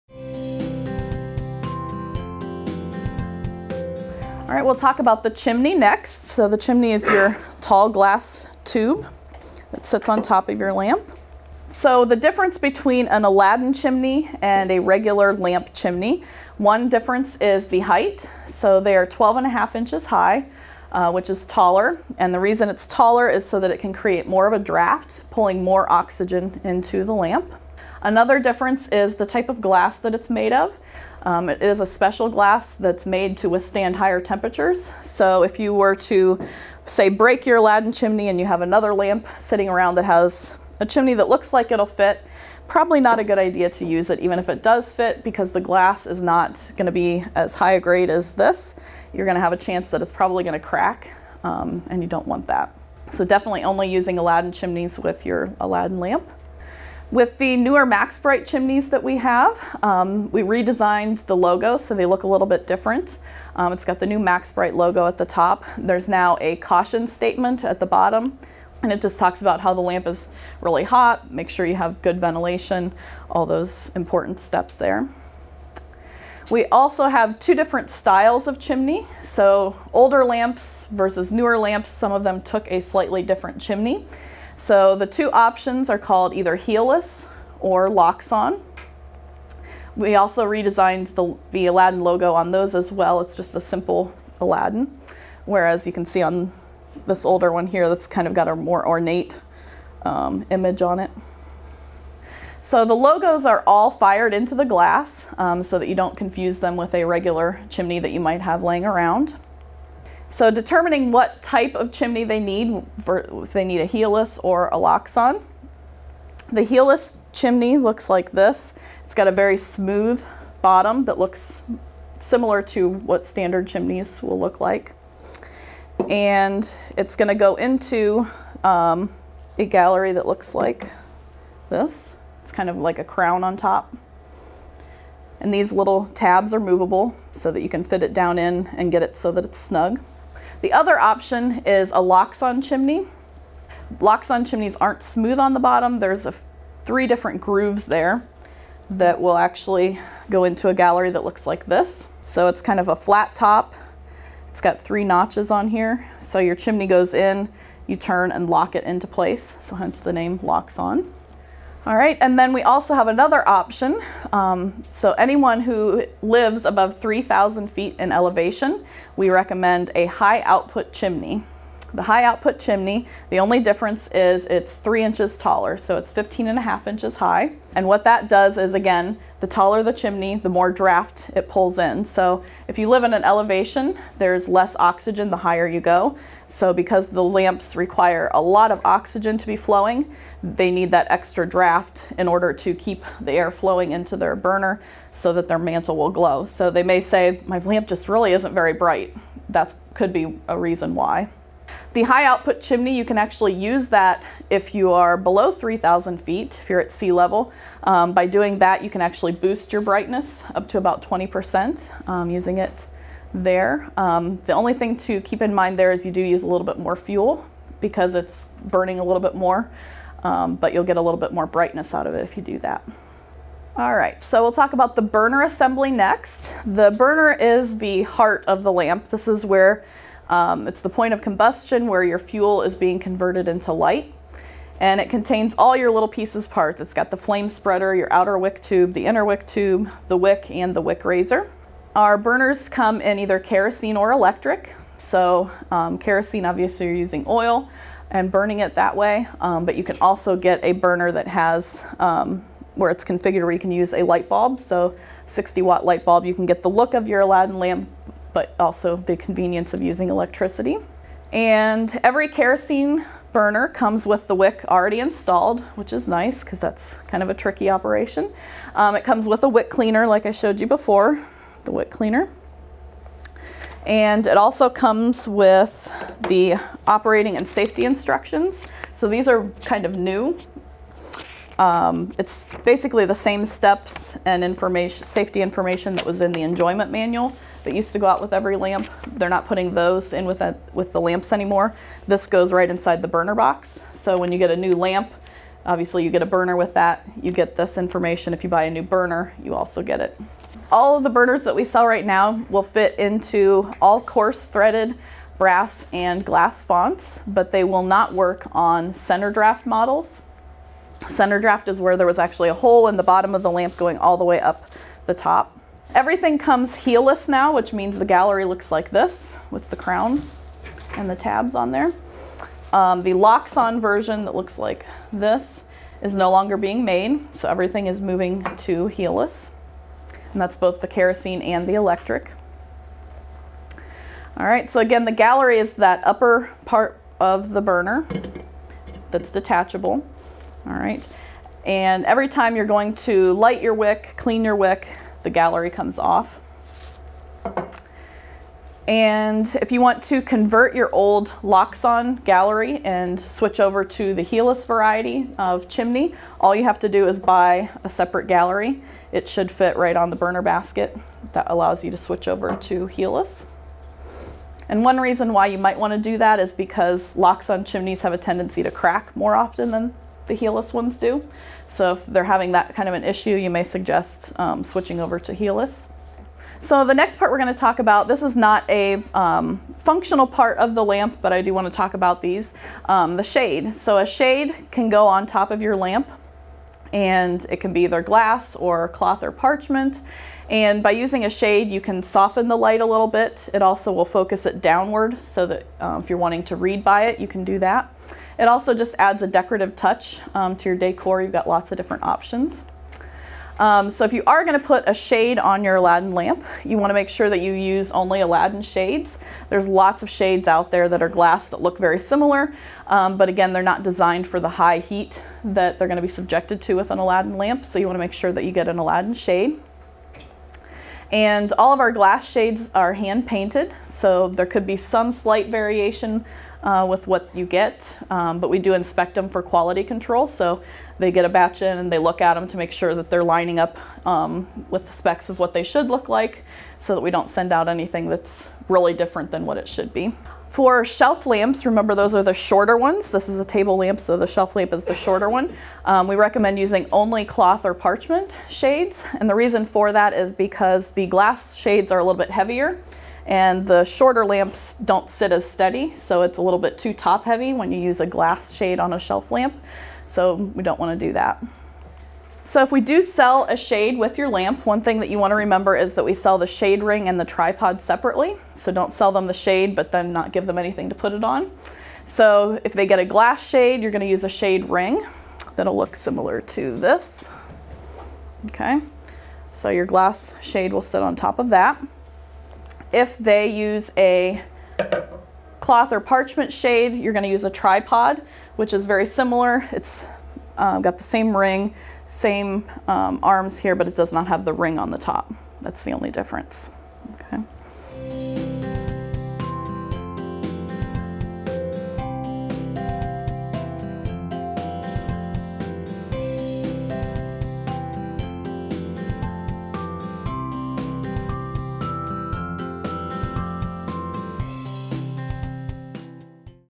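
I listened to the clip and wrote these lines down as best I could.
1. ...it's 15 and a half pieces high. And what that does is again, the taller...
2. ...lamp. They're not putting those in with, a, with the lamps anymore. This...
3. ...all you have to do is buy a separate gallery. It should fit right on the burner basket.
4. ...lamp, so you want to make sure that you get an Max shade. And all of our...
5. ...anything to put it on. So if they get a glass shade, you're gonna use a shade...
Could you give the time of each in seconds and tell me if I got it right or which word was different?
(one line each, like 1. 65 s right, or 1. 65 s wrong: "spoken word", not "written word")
1. 175 s wrong: "inches", not "pieces"
2. 288 s right
3. 356 s right
4. 417 s wrong: "Aladdin", not "Max"
5. 470 s right.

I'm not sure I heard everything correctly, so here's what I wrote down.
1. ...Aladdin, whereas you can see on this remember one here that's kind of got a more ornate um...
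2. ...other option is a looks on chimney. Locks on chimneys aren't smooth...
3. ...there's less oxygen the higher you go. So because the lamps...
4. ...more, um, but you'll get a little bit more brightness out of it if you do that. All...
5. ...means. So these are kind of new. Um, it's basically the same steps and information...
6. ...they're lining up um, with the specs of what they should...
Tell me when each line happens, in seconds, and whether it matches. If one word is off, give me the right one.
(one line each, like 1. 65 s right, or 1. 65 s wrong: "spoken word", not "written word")
1. 94 s wrong: "older", not "remember"
2. 140 s wrong: "locks", not "looks"
3. 184 s right
4. 219 s right
5. 277 s wrong: "instructions", not "means"
6. 433 s right.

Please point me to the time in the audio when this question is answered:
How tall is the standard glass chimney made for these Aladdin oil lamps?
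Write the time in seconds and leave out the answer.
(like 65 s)
19 s.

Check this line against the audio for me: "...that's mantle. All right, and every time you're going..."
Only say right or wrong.
wrong.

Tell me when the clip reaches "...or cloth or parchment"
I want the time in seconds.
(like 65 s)
388 s.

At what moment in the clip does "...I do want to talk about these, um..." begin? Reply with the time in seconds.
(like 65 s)
381 s.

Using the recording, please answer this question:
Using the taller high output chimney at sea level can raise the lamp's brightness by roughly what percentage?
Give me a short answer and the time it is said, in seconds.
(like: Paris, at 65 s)
20%, at 211 s.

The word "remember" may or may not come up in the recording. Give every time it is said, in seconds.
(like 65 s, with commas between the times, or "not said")
441 s, 465 s.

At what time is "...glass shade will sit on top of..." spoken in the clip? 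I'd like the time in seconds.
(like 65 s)
479 s.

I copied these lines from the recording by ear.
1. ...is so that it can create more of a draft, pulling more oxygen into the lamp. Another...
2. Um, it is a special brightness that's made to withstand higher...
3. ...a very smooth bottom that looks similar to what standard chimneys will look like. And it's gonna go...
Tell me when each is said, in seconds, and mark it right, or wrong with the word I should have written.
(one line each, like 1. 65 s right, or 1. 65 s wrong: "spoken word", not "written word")
1. 23 s right
2. 31 s wrong: "glass", not "brightness"
3. 119 s right.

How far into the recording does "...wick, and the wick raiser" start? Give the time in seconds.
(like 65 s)
240 s.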